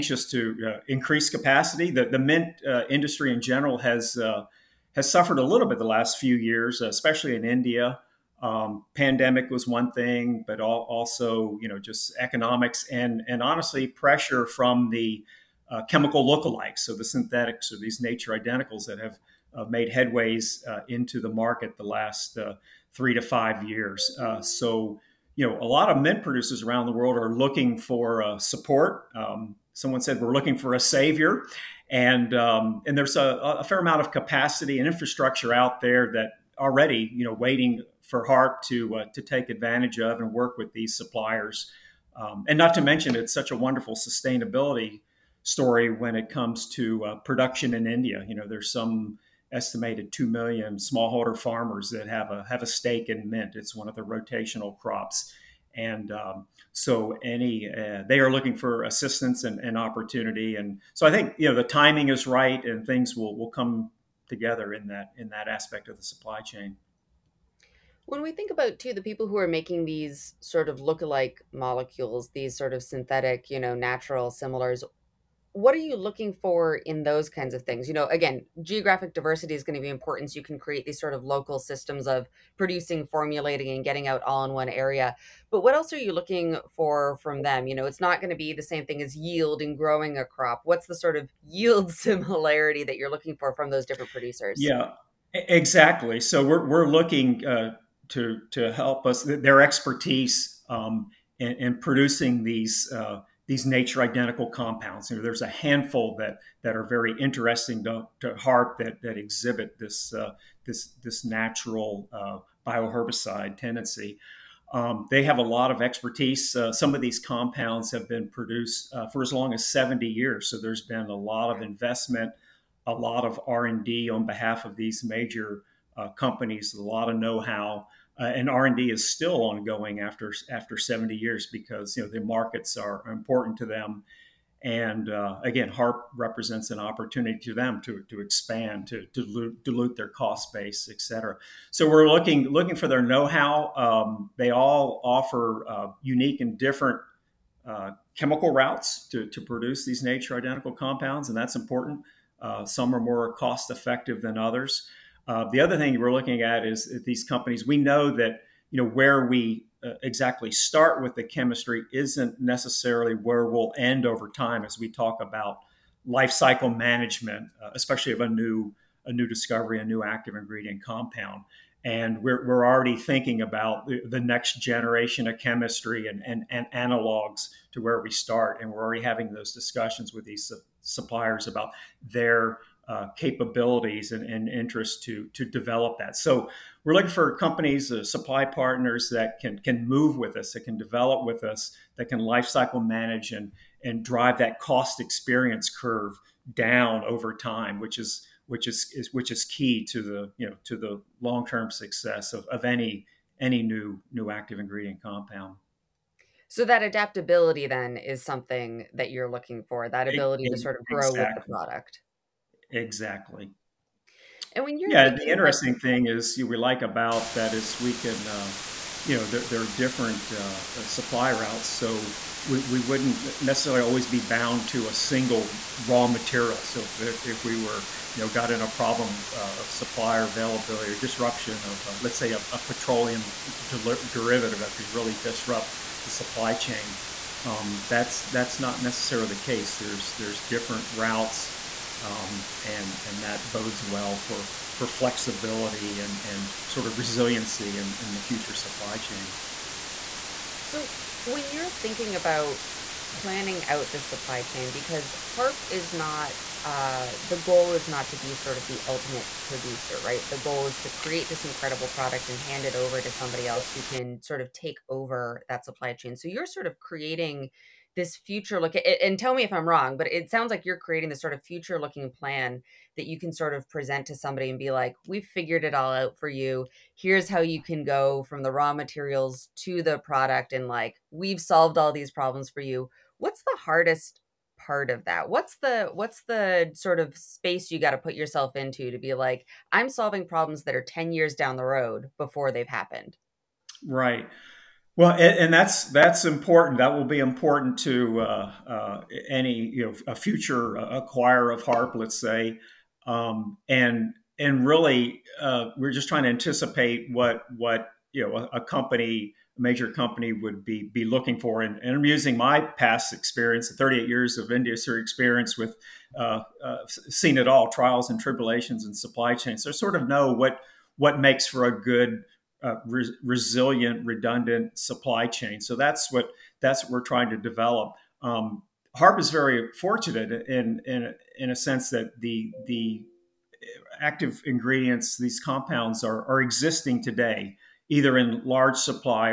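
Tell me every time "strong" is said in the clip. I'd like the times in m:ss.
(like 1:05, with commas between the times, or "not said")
not said.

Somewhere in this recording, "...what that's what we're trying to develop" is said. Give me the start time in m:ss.
5:26.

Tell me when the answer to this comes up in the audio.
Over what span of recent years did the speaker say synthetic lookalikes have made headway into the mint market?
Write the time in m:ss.
0:22.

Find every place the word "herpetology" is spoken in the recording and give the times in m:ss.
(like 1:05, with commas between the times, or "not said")
not said.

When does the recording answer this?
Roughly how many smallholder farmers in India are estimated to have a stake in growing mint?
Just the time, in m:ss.
0:50.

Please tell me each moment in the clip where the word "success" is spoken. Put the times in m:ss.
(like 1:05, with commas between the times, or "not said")
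3:21.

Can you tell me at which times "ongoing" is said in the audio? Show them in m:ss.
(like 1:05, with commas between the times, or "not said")
2:09.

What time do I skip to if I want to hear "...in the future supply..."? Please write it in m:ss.
4:07.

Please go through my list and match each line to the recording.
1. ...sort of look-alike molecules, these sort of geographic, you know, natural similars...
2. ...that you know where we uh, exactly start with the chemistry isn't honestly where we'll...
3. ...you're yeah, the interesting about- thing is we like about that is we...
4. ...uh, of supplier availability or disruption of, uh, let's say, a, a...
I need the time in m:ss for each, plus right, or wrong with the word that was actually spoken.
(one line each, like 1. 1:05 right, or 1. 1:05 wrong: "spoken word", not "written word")
1. 1:10 wrong: "synthetic", not "geographic"
2. 2:38 wrong: "necessarily", not "honestly"
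3. 3:34 right
4. 3:49 right.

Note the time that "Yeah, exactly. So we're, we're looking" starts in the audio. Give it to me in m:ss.
1:34.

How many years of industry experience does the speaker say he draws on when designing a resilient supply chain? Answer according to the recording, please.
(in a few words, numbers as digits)
38.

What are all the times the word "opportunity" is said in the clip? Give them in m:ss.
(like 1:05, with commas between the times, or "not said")
0:59, 2:16.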